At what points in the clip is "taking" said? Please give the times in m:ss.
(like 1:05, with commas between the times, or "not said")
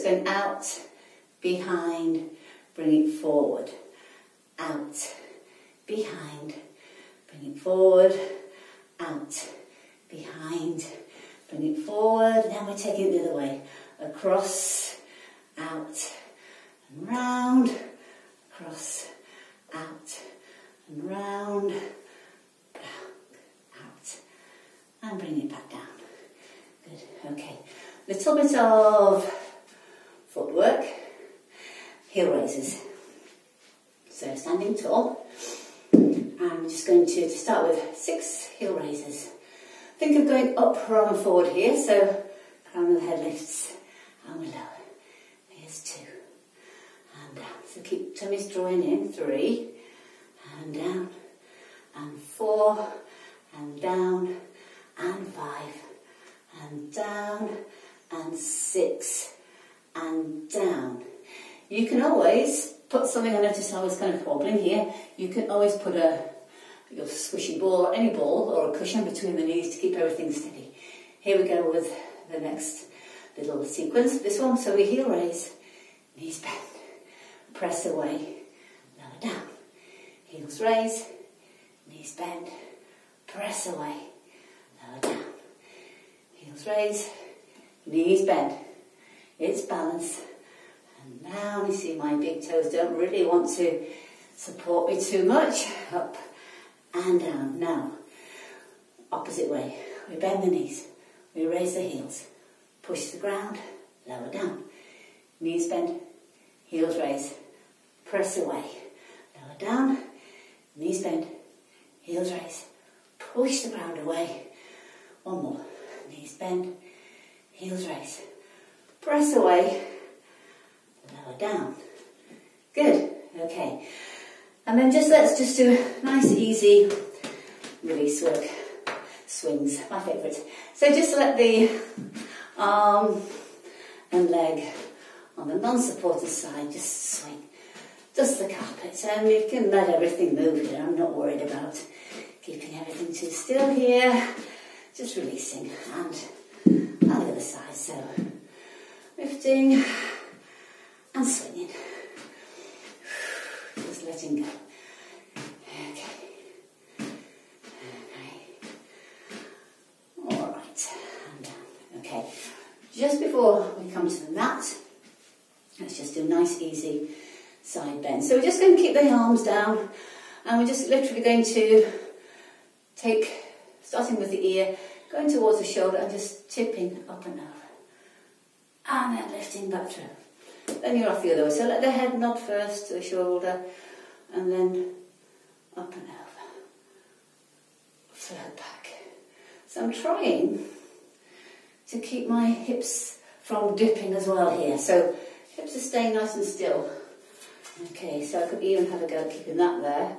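0:12.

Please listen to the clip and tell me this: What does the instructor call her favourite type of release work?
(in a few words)
swings.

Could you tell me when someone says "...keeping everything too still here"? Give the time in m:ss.
2:22.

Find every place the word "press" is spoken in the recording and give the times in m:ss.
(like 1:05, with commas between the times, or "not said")
1:17, 1:23, 1:48, 1:59.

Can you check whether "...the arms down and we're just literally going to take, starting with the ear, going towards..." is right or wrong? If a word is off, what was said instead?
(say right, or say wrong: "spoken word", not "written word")
right.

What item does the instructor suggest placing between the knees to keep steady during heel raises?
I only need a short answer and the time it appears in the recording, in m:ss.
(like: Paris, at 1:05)
squishy ball, at 1:07.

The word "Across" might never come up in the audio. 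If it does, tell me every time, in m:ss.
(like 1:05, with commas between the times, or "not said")
0:14, 0:18.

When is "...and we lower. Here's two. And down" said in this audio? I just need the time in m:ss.
0:44.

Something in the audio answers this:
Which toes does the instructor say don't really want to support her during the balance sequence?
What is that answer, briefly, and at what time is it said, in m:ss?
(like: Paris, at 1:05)
big toes, at 1:32.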